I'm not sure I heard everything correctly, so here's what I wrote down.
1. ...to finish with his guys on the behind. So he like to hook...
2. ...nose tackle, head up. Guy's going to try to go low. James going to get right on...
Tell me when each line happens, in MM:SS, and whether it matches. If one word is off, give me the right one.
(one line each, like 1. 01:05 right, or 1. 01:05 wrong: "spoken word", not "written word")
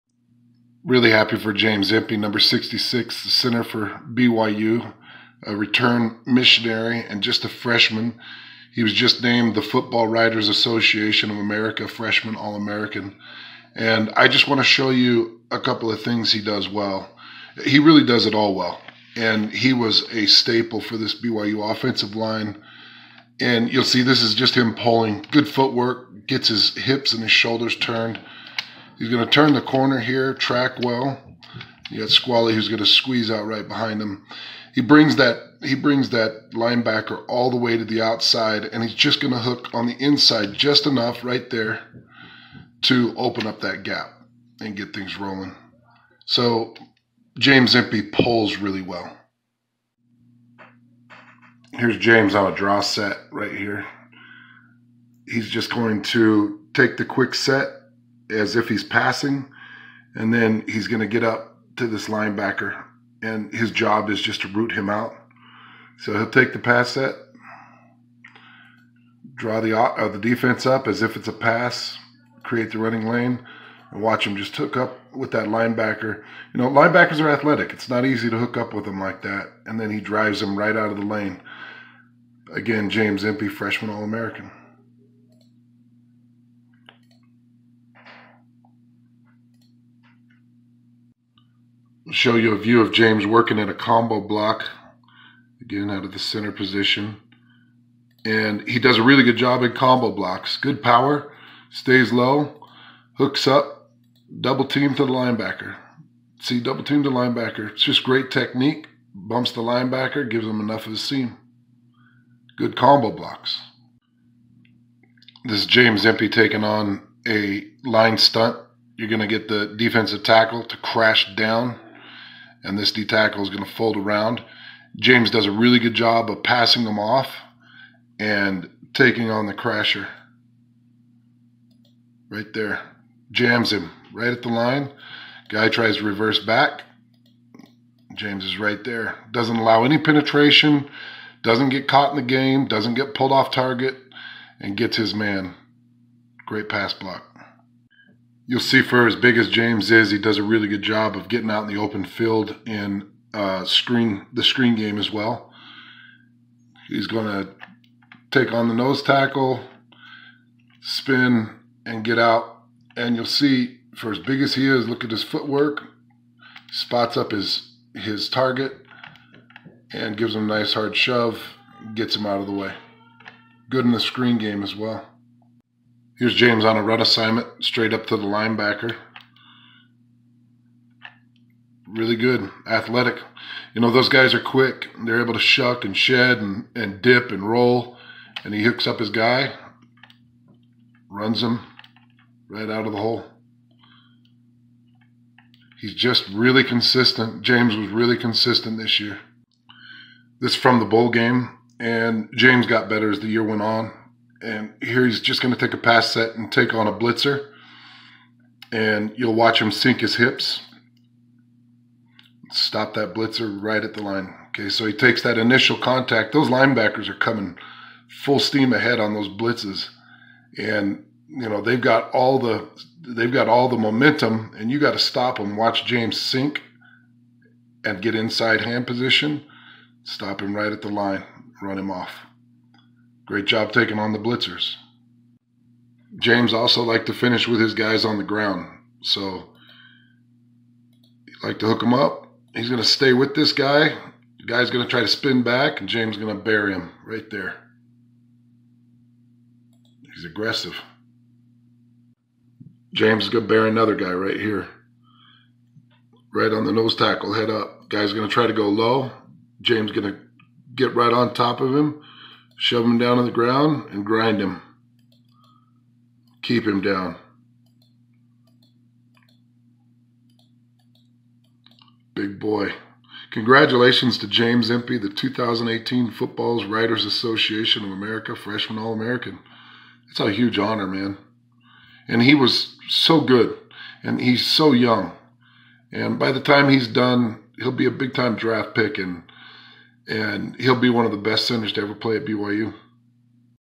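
1. 03:57 wrong: "ground", not "behind"
2. 04:16 right.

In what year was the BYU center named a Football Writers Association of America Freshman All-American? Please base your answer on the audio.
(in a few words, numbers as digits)
2018.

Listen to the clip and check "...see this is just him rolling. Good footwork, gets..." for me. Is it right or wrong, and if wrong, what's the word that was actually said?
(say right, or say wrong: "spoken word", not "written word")
wrong: "pulling", not "rolling".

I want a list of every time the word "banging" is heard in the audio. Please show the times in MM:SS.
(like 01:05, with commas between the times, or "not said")
not said.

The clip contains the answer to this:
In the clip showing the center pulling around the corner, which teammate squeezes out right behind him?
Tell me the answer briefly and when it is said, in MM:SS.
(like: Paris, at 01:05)
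Squally, at 00:32.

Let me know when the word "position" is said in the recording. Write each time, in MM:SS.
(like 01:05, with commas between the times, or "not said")
01:36, 03:48.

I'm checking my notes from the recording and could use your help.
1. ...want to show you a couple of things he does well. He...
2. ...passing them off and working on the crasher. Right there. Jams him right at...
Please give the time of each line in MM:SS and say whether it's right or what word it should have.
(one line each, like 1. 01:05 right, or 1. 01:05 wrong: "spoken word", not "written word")
1. 00:14 right
2. 02:06 wrong: "taking", not "working".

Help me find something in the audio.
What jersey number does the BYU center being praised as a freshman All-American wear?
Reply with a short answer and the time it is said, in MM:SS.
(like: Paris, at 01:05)
66, at 00:02.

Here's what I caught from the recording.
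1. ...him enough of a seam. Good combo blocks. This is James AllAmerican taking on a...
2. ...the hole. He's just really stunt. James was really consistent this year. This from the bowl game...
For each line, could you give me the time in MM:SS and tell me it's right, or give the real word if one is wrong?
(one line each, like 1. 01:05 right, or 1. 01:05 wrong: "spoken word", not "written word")
1. 01:50 wrong: "Empey", not "AllAmerican"
2. 03:12 wrong: "consistent", not "stunt".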